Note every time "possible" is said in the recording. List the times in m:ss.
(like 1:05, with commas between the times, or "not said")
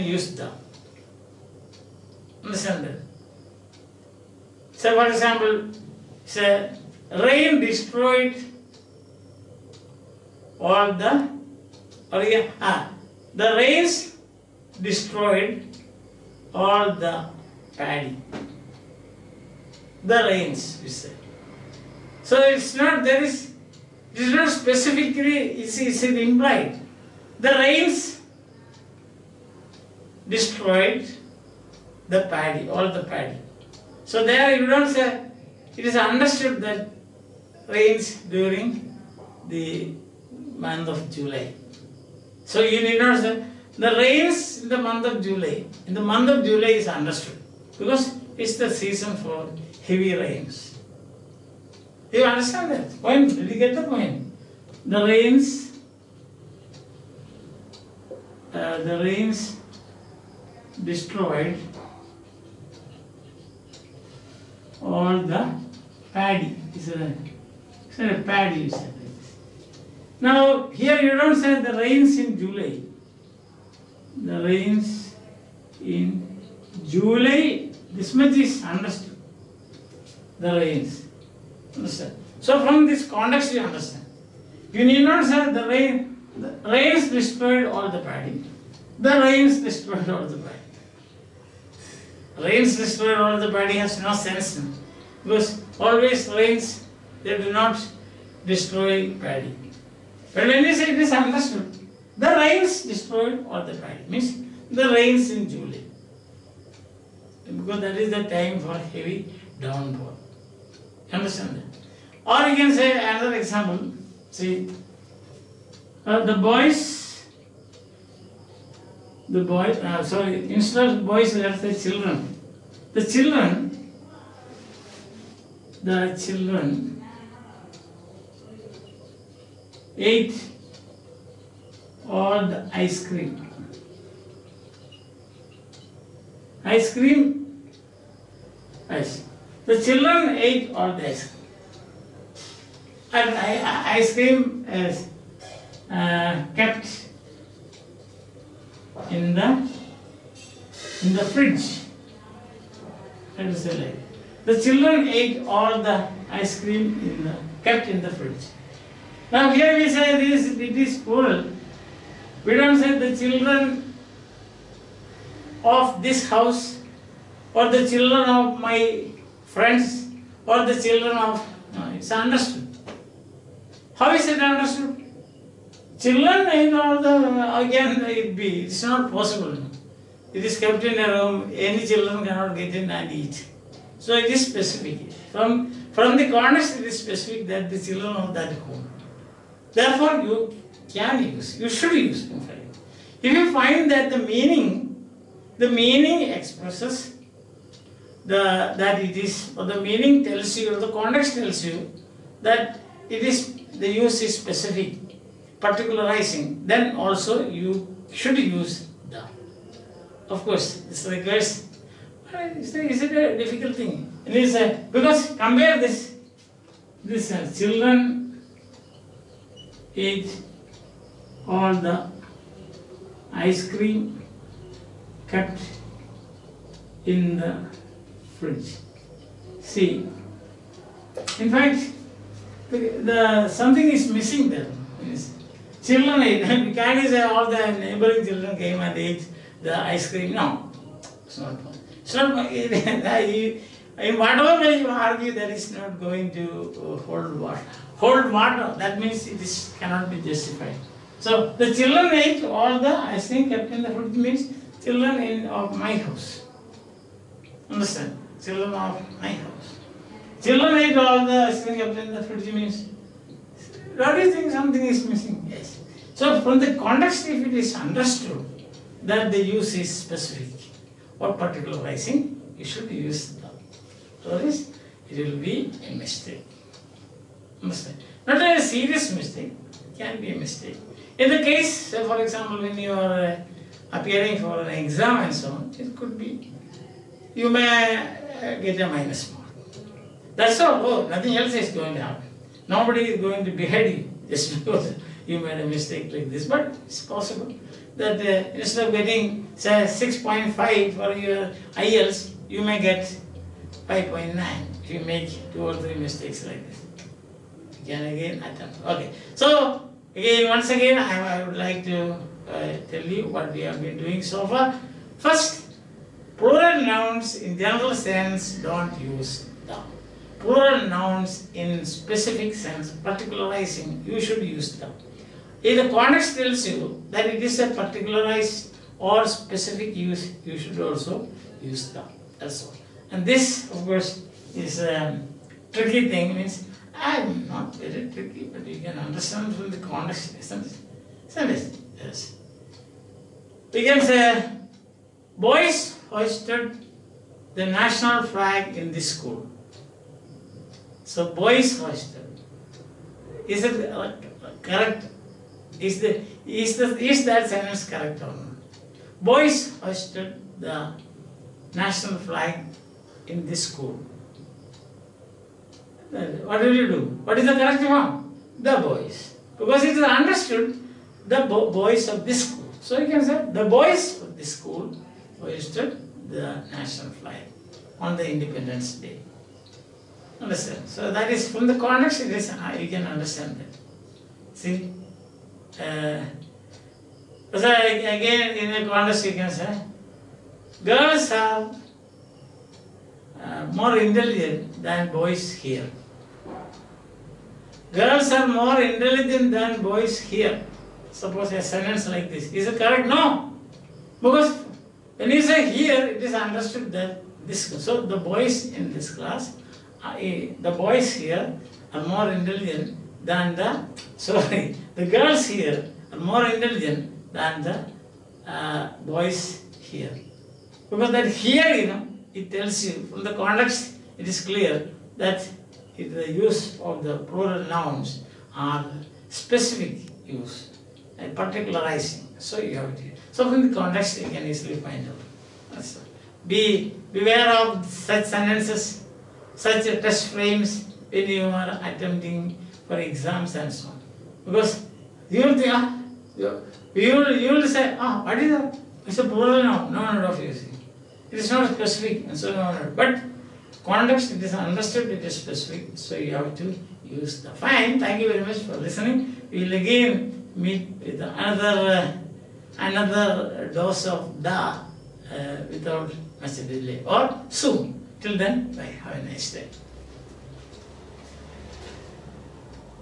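2:59, 4:57.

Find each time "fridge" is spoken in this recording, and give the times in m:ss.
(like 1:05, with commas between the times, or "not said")
2:31, 2:38, 3:48, 4:13, 4:22.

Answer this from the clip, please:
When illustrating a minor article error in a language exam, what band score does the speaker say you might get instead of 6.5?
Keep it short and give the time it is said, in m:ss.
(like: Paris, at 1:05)
5.9, at 5:03.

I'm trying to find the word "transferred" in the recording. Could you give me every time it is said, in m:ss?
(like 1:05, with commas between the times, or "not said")
not said.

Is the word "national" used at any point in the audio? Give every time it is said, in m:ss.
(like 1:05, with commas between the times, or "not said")
5:47, 6:01, 6:16.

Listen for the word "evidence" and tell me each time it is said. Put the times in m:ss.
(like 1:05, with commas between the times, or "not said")
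not said.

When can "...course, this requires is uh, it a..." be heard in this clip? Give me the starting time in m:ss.
3:30.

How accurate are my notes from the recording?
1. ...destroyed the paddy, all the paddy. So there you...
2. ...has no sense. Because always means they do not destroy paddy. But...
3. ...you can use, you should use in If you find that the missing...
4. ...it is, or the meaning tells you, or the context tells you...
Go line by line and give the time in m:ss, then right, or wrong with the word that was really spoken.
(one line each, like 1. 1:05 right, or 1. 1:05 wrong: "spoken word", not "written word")
1. 0:30 right
2. 1:33 wrong: "rains", not "means"
3. 3:10 wrong: "meaning", not "missing"
4. 3:19 right.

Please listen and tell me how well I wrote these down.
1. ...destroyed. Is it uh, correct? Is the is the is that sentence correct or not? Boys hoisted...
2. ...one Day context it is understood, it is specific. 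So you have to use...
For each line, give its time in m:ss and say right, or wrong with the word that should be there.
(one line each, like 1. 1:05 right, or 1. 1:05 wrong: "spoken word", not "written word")
1. 5:51 wrong: "hoisted", not "destroyed"
2. 7:32 wrong: "But", not "Day".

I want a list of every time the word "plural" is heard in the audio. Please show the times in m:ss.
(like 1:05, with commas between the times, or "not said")
5:16, 5:20, 7:07, 7:29.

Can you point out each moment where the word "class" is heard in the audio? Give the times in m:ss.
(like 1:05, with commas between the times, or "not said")
6:49.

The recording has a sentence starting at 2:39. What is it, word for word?
Now here we say this, it is school.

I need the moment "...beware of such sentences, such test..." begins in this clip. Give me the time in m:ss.
7:17.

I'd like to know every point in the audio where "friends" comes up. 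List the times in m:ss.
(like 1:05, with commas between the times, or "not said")
2:49.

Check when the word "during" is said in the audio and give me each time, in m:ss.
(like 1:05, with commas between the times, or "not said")
0:38.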